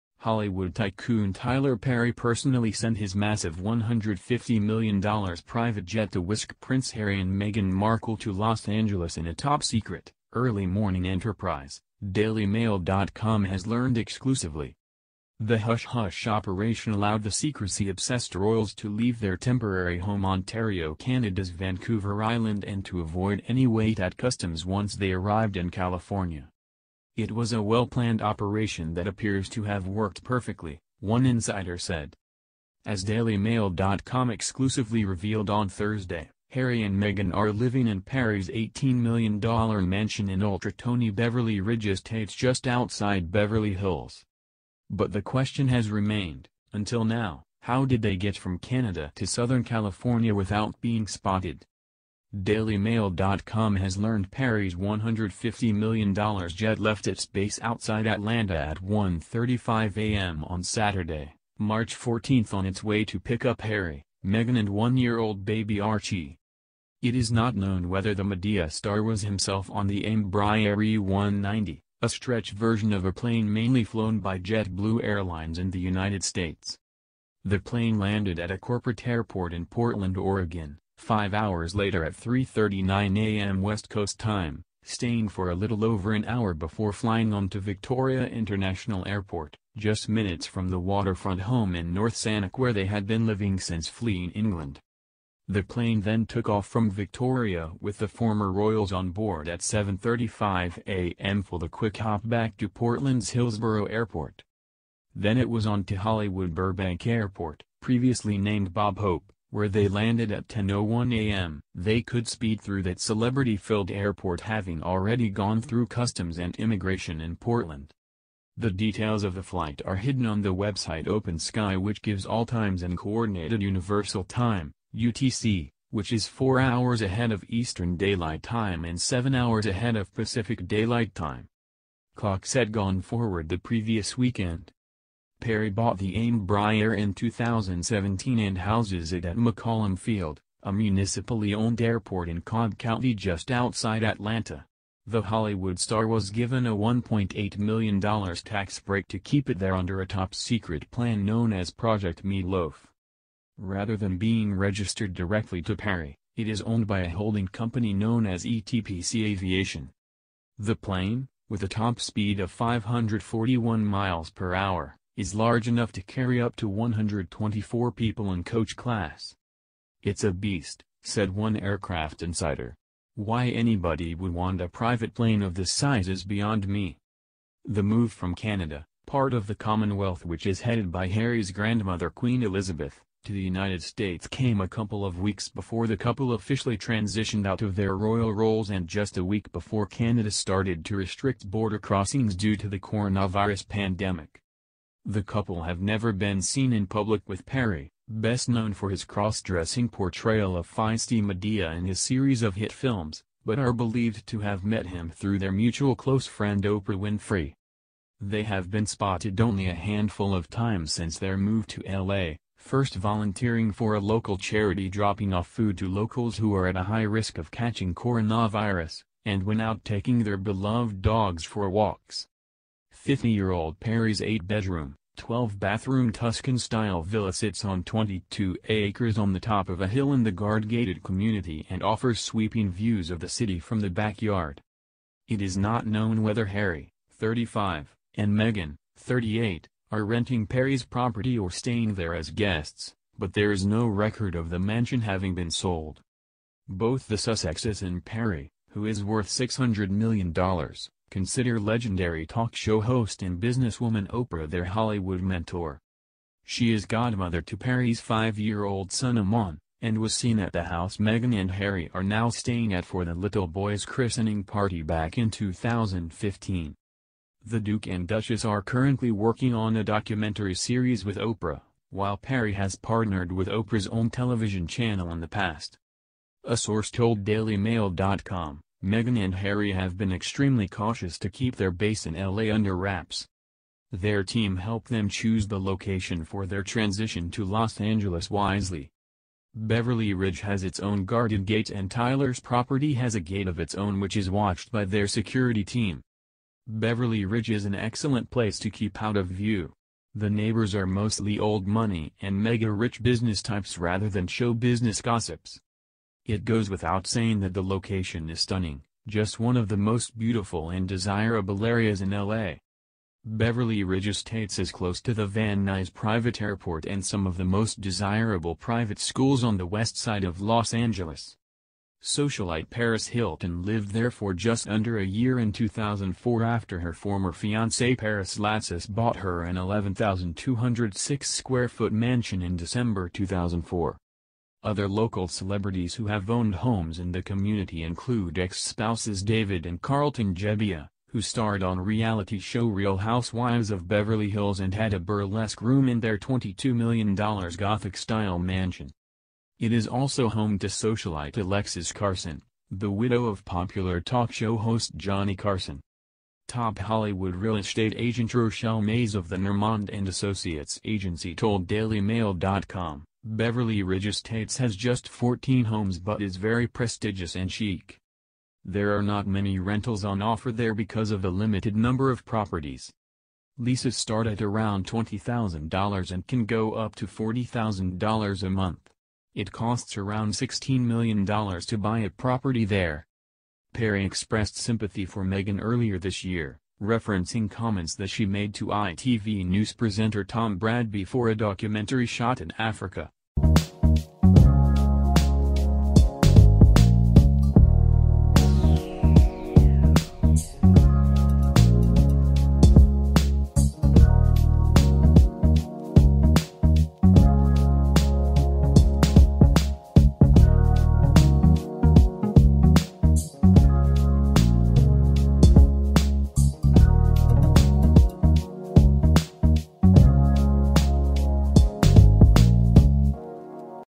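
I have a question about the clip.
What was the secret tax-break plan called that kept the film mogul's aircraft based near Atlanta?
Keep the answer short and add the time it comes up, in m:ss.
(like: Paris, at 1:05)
Project Meatloaf, at 2:31.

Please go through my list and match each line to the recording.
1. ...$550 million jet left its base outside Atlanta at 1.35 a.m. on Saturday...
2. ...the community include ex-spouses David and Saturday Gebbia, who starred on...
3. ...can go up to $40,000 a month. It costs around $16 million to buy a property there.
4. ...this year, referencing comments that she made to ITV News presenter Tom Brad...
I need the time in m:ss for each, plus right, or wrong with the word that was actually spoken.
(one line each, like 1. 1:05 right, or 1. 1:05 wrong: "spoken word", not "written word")
1. 0:54 wrong: "150", not "550"
2. 5:37 wrong: "Carlton", not "Saturday"
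3. 6:16 right
4. 6:25 right.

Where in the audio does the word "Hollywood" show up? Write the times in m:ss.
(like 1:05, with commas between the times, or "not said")
0:00, 1:45, 2:25, 4:14, 5:56.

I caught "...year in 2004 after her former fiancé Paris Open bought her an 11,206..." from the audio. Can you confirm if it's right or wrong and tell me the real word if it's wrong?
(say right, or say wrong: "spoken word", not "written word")
wrong: "Latsis", not "Open".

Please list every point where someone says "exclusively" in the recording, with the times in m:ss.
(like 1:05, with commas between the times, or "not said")
0:13, 0:34.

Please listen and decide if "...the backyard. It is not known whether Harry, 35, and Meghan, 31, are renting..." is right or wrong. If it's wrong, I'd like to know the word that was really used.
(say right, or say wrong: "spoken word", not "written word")
wrong: "38", not "31".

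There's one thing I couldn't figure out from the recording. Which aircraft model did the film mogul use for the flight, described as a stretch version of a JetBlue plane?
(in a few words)
Embraer E190.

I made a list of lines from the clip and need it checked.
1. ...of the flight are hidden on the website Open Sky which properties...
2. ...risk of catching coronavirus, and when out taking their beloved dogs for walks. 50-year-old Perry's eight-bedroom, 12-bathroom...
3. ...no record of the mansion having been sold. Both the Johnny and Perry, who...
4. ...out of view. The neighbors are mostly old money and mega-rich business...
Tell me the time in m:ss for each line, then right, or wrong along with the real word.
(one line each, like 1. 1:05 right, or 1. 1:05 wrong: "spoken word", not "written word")
1. 1:59 wrong: "gives", not "properties"
2. 3:37 right
3. 4:03 wrong: "Sussexes", not "Johnny"
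4. 4:59 right.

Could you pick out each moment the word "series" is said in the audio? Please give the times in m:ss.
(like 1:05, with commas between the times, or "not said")
3:21, 4:30.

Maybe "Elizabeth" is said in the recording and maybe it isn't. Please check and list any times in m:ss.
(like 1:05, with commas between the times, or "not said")
3:02.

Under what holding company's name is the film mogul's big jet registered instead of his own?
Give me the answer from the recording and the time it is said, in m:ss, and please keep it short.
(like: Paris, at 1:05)
ETPC Aviation, at 2:38.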